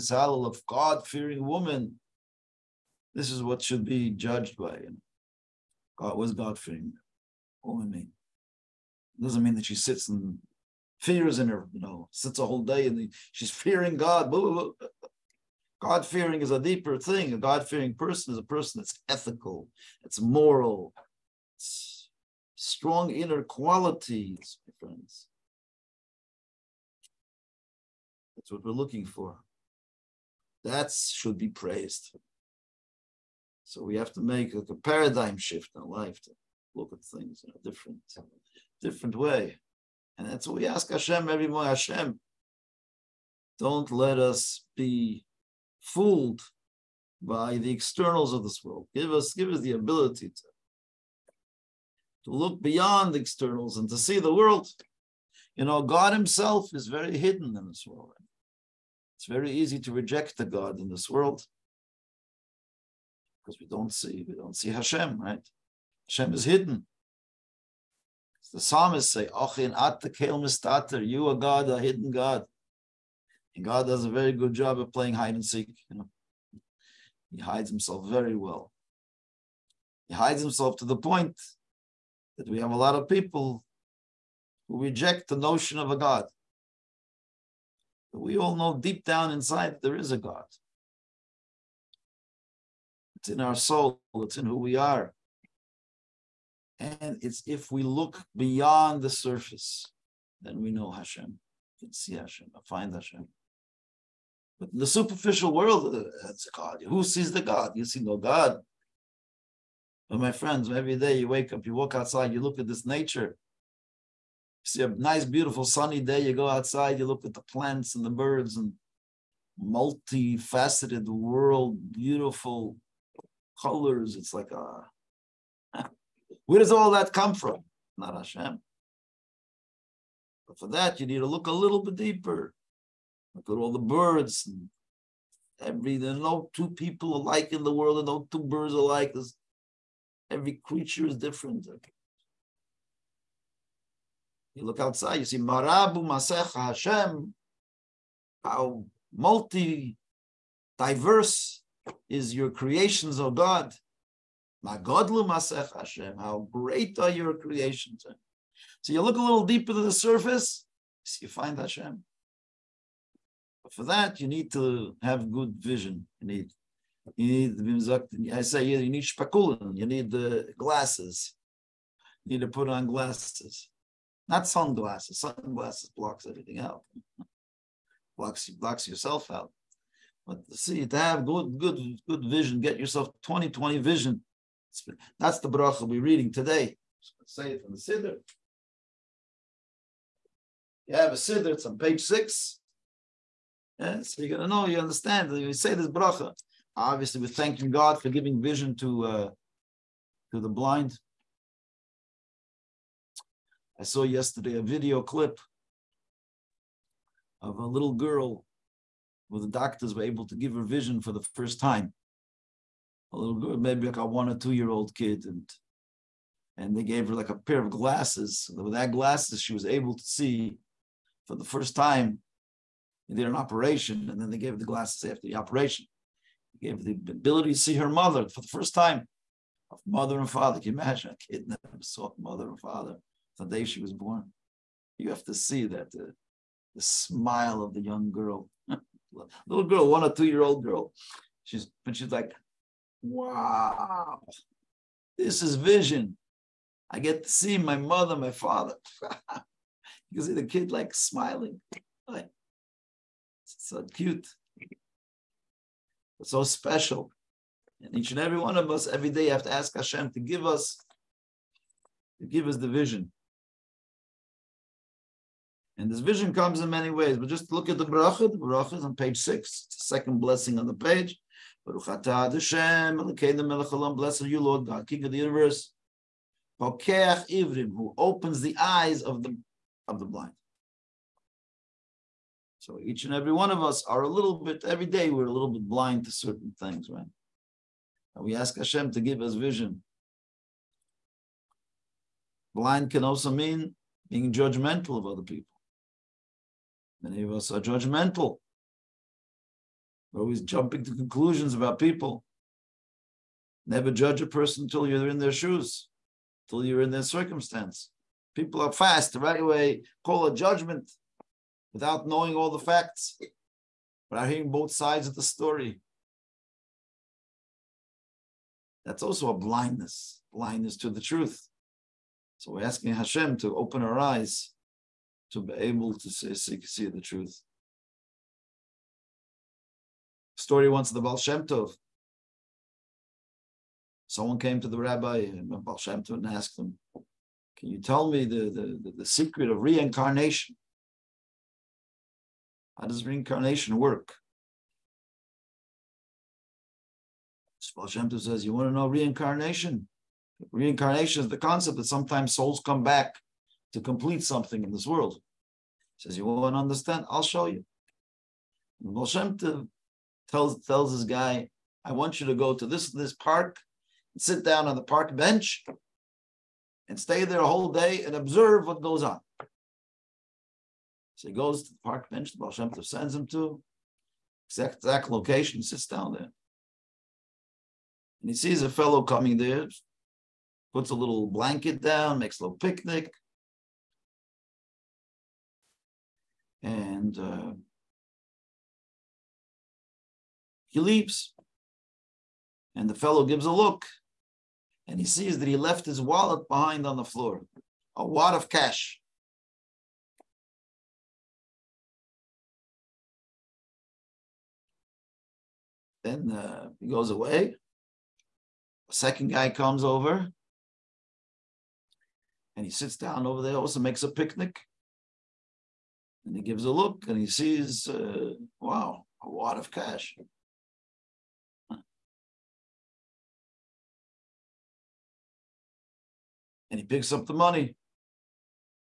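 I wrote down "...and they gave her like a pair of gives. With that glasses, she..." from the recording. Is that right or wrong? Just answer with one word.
wrong.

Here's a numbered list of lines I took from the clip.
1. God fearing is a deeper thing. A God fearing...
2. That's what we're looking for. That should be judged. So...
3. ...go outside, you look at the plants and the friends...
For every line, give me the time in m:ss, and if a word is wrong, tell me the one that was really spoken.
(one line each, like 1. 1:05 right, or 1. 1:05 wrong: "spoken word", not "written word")
1. 0:15 right
2. 0:28 wrong: "praised", not "judged"
3. 1:56 wrong: "birds", not "friends".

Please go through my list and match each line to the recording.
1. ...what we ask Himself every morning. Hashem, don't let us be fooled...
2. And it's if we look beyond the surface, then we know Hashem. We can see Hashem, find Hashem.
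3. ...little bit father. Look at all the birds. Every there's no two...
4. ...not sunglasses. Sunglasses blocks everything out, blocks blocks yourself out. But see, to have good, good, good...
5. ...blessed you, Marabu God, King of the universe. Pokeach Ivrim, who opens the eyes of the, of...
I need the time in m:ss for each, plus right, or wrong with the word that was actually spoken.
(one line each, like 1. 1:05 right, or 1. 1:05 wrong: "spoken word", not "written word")
1. 0:40 wrong: "Hashem", not "Himself"
2. 1:36 right
3. 2:11 wrong: "deeper", not "father"
4. 2:54 right
5. 4:33 wrong: "Lord", not "Marabu".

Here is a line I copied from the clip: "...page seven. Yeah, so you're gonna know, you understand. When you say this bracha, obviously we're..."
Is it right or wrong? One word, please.
wrong.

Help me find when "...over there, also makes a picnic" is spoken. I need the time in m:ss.
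6:53.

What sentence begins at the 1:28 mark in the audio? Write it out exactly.
But we all know deep down inside there is a God.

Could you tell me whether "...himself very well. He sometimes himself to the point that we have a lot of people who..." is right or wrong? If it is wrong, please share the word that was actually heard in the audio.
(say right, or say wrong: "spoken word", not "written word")
wrong: "hides", not "sometimes".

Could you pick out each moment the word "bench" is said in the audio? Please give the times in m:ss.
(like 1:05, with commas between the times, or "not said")
6:05, 6:12.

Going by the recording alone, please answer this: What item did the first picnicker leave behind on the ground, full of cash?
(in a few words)
His wallet.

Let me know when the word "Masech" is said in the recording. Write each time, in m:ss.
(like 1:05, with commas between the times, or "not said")
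2:25, 2:35.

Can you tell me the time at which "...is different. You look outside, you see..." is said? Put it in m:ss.
2:21.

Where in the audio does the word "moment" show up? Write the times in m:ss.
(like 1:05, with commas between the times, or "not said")
not said.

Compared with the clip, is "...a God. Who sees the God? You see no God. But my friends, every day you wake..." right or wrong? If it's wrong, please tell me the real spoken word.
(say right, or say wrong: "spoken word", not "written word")
right.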